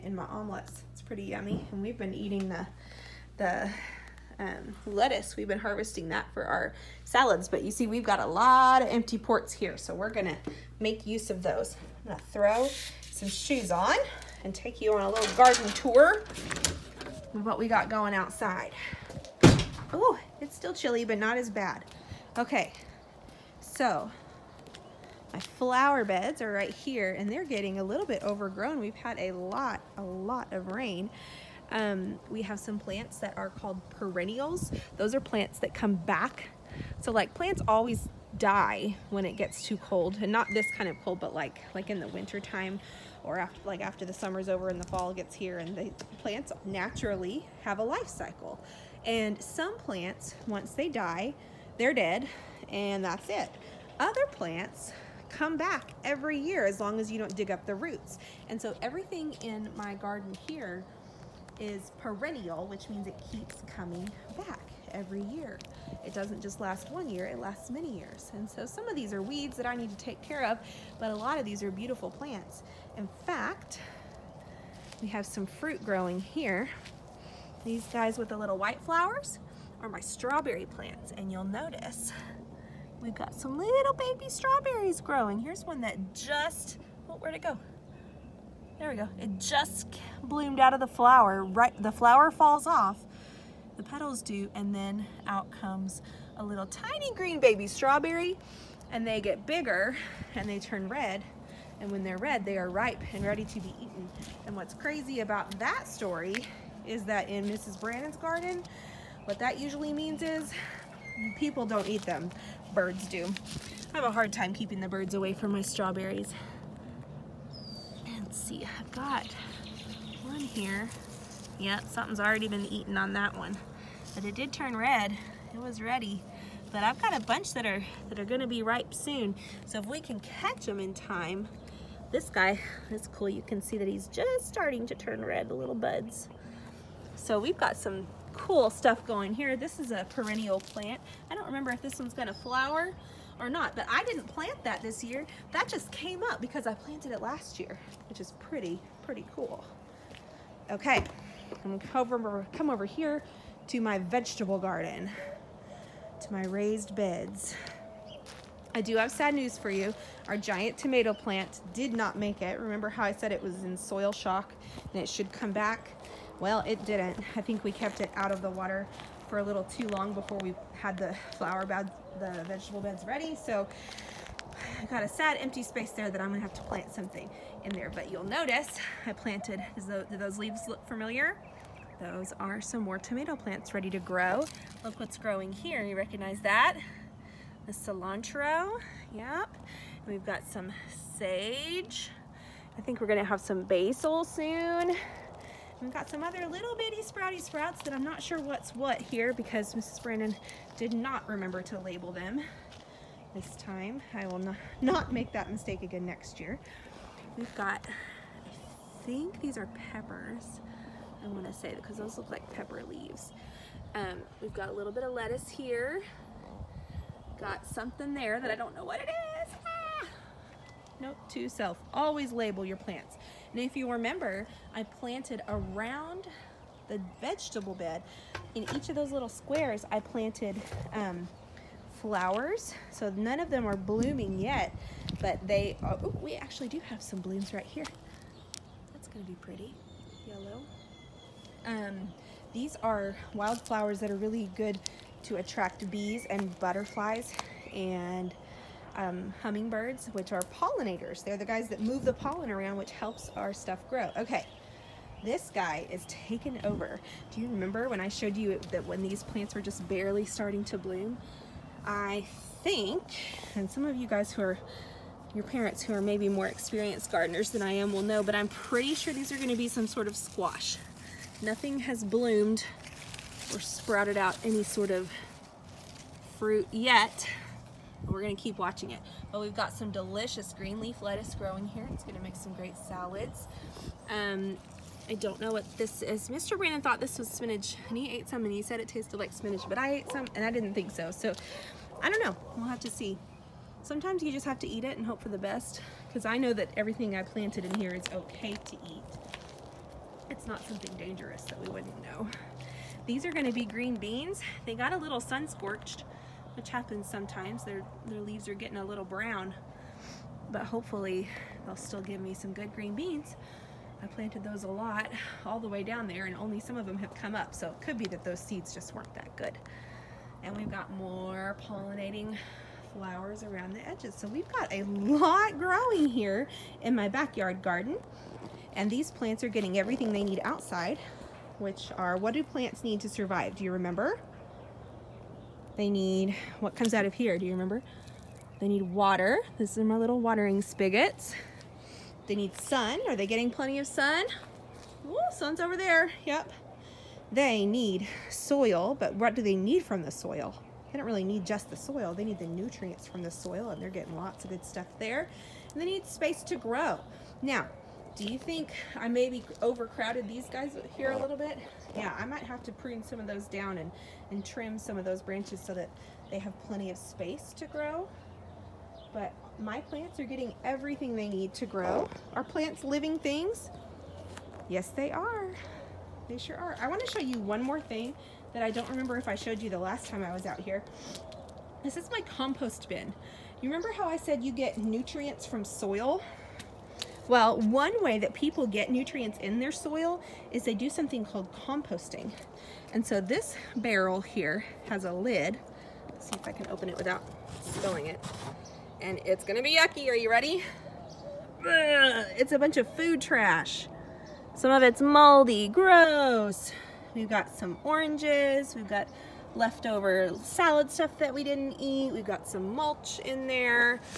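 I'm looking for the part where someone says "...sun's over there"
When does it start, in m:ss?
5:45.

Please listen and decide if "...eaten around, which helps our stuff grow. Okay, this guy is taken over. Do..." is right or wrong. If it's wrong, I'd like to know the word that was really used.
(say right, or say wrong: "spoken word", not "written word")
wrong: "pollen", not "eaten".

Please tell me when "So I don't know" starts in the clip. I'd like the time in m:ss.
4:51.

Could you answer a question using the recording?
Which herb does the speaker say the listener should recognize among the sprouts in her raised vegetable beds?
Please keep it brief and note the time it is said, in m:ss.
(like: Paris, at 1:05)
Cilantro, at 3:07.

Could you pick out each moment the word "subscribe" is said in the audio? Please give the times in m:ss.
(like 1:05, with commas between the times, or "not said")
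not said.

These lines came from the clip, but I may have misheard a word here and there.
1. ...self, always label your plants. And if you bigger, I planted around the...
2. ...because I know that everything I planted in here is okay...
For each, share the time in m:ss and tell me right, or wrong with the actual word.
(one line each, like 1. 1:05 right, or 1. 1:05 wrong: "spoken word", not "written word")
1. 3:41 wrong: "remember", not "bigger"
2. 4:56 right.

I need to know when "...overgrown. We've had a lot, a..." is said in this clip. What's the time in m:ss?
0:28.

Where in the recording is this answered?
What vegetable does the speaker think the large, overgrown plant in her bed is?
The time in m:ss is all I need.
4:30.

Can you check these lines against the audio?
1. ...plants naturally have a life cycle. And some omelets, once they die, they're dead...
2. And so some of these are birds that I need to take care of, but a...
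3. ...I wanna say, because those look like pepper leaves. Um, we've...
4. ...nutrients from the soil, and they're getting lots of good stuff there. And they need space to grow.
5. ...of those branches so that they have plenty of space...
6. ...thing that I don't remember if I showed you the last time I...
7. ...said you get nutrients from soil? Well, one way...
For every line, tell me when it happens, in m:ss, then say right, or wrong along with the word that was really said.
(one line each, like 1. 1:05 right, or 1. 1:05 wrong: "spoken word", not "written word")
1. 0:46 wrong: "plants", not "omelets"
2. 1:08 wrong: "weeds", not "birds"
3. 3:31 right
4. 5:52 right
5. 6:04 right
6. 6:17 right
7. 6:24 right.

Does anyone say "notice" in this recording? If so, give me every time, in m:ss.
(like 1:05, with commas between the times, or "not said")
1:21, 2:58.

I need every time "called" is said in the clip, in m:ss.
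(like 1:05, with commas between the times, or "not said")
0:33, 6:31.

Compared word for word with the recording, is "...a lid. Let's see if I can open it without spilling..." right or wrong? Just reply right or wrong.
right.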